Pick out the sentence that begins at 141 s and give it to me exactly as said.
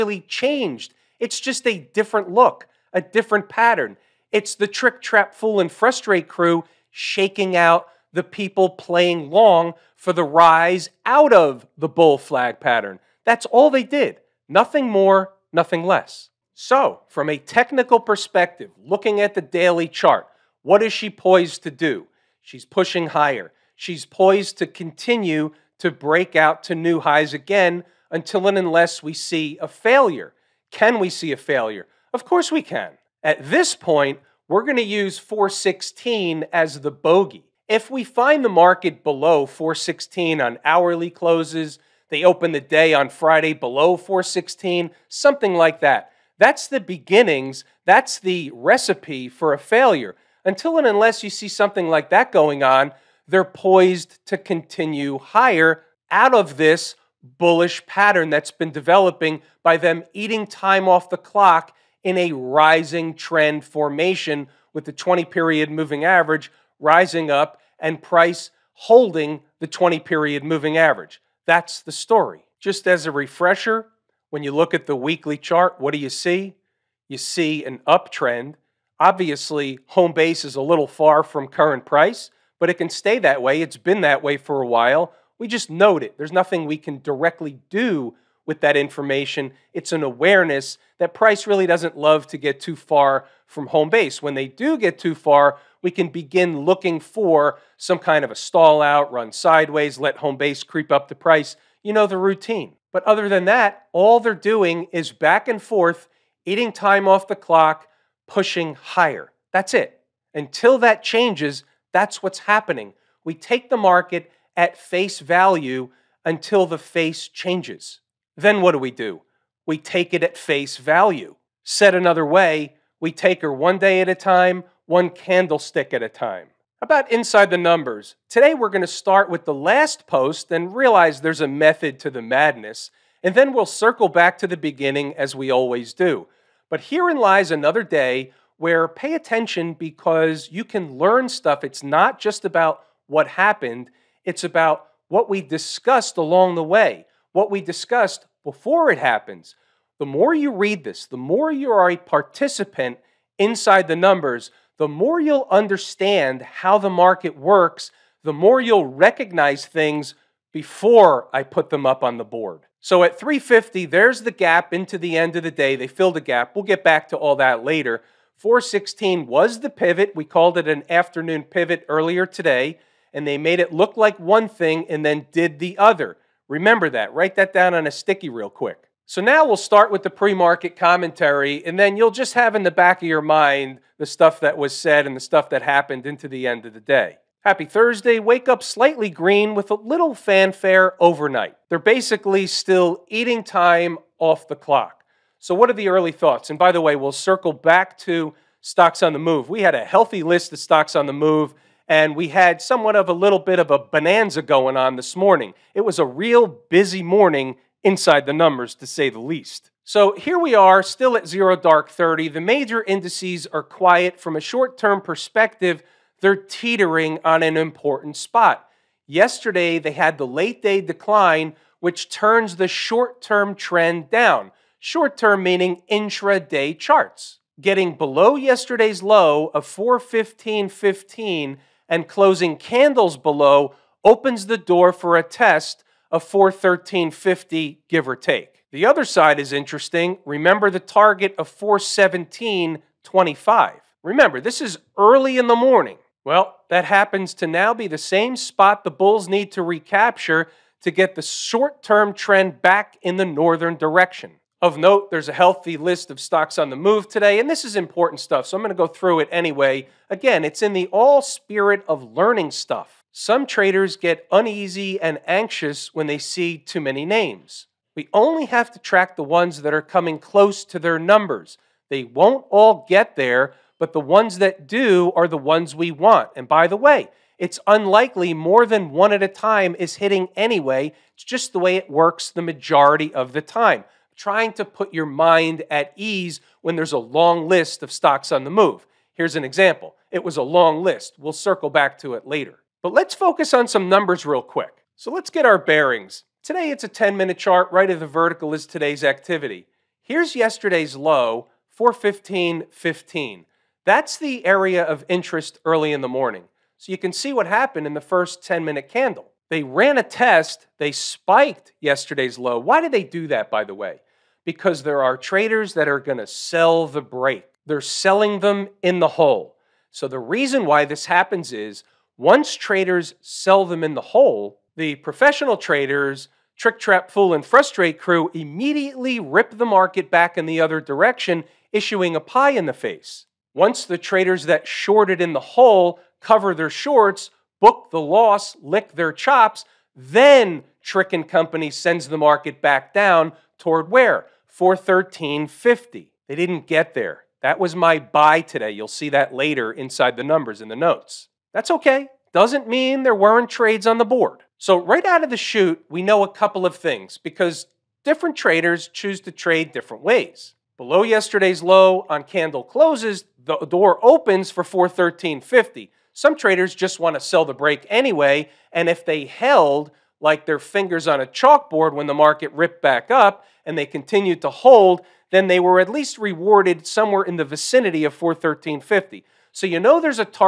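It's not just about what happened, it's about what we discussed along the way what we discussed before it happens.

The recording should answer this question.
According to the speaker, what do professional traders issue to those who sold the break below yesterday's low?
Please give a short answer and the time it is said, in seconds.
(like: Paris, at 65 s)
a pie in the face, at 332 s.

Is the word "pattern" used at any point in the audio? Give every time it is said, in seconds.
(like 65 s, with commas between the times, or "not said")
3 s, 12 s, 57 s.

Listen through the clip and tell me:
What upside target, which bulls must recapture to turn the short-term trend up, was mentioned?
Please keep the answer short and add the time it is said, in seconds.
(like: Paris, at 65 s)
417.25, at 241 s.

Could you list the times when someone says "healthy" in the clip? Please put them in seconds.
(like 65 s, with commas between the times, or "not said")
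199 s, 255 s.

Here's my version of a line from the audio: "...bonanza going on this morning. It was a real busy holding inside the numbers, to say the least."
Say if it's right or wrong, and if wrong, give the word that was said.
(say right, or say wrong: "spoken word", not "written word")
wrong: "morning", not "holding".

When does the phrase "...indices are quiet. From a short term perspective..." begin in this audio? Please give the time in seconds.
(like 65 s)
212 s.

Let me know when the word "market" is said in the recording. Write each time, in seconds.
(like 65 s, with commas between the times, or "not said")
38 s, 113 s, 156 s, 180 s, 329 s, 342 s, 372 s.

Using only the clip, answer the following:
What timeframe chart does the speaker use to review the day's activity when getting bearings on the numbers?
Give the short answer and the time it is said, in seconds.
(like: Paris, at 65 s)
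10 minute, at 296 s.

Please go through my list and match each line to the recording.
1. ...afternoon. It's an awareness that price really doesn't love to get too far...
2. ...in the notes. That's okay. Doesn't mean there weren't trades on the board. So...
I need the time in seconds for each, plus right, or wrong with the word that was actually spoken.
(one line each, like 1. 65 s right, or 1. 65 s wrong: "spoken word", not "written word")
1. 88 s wrong: "information", not "afternoon"
2. 350 s right.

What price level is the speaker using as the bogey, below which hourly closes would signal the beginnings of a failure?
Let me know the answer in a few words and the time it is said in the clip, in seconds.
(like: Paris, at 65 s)
416, at 35 s.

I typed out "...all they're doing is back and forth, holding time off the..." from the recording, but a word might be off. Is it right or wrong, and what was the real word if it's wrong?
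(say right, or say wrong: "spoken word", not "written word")
wrong: "eating", not "holding".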